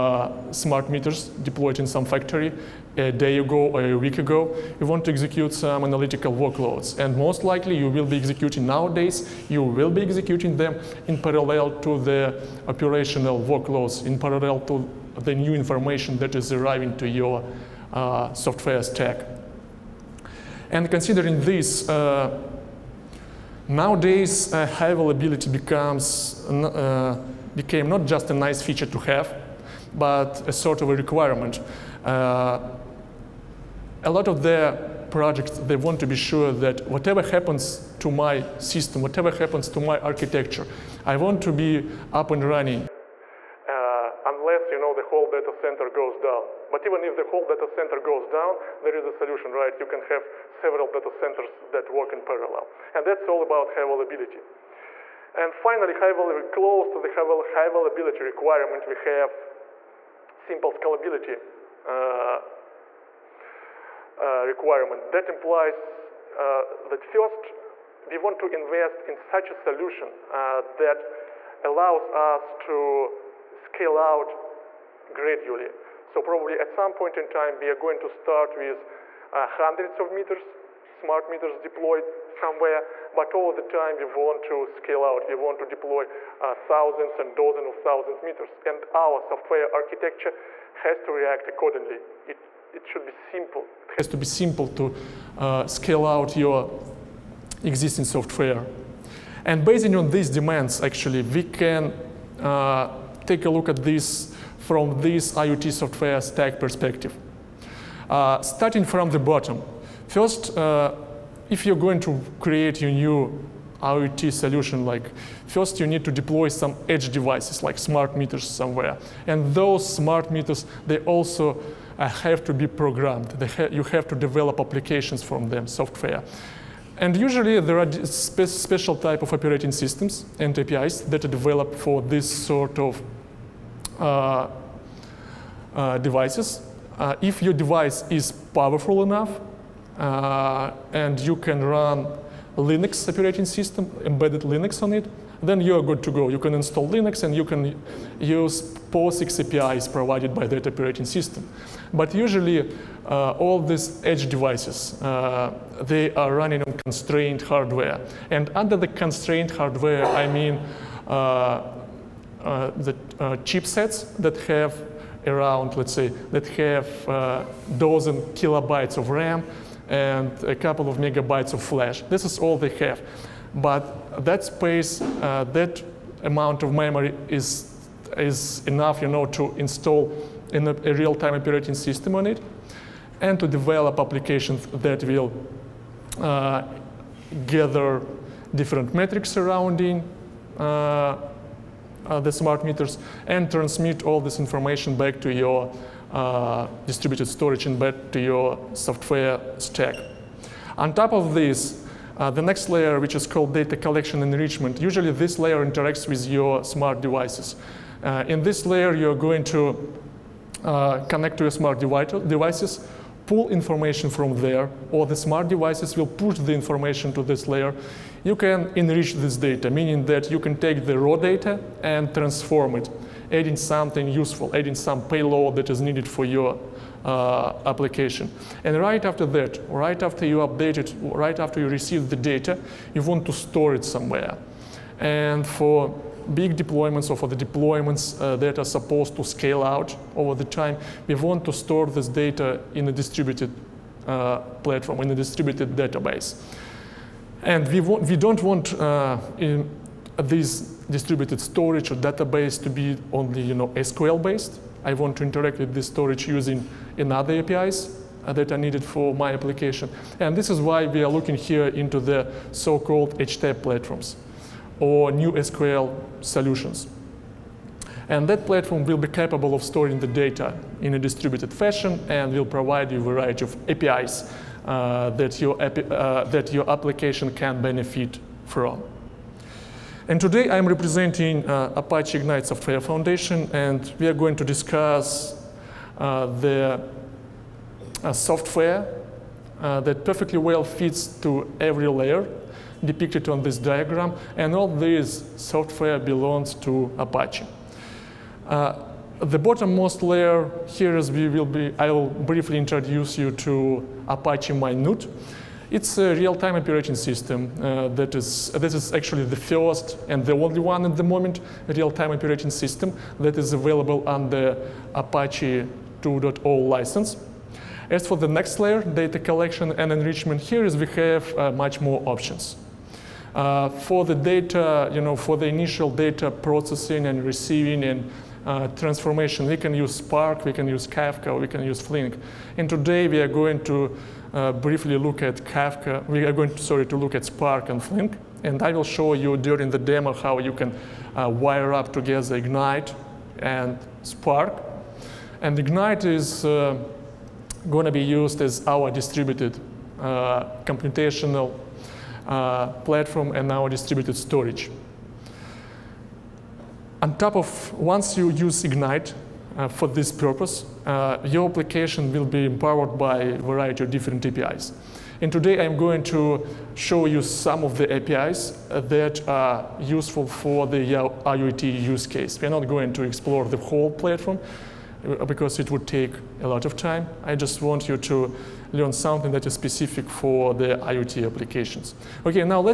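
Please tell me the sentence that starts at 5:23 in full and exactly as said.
Uh, for the data, you know, for the initial data processing and receiving and uh, transformation.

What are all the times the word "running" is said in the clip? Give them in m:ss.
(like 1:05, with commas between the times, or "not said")
0:42, 2:36.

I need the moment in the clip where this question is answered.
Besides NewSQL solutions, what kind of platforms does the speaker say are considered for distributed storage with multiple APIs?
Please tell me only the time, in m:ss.
4:23.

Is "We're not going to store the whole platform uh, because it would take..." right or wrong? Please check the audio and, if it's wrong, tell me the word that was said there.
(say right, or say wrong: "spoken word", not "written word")
wrong: "explore", not "store".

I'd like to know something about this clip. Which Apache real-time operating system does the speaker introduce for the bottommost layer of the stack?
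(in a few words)
Apache Mynewt.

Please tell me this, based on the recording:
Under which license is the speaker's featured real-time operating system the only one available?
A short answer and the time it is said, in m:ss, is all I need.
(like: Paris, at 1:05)
Apache 2.0, at 5:14.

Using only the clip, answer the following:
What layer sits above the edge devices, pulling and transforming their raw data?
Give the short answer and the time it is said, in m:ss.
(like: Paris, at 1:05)
data collection enrichment, at 3:23.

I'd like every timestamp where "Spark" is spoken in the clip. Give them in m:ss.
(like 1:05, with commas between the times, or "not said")
5:29, 5:37, 5:44.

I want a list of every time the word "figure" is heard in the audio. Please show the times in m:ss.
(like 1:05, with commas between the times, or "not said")
not said.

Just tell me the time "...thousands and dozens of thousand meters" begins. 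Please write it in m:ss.
1:26.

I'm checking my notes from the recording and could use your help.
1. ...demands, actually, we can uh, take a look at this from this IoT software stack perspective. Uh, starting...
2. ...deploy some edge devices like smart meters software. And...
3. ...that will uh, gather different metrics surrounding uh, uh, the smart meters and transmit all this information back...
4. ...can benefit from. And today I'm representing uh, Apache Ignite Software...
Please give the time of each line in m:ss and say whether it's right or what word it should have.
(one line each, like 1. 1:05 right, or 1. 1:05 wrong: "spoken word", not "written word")
1. 1:40 right
2. 1:56 wrong: "somewhere", not "software"
3. 3:04 right
4. 4:37 right.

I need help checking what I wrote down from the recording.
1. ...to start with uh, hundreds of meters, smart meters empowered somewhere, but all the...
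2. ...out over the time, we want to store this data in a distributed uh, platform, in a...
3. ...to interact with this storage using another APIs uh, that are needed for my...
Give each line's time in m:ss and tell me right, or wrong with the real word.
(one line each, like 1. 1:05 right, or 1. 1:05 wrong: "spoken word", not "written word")
1. 1:17 wrong: "deployed", not "empowered"
2. 3:59 right
3. 4:15 right.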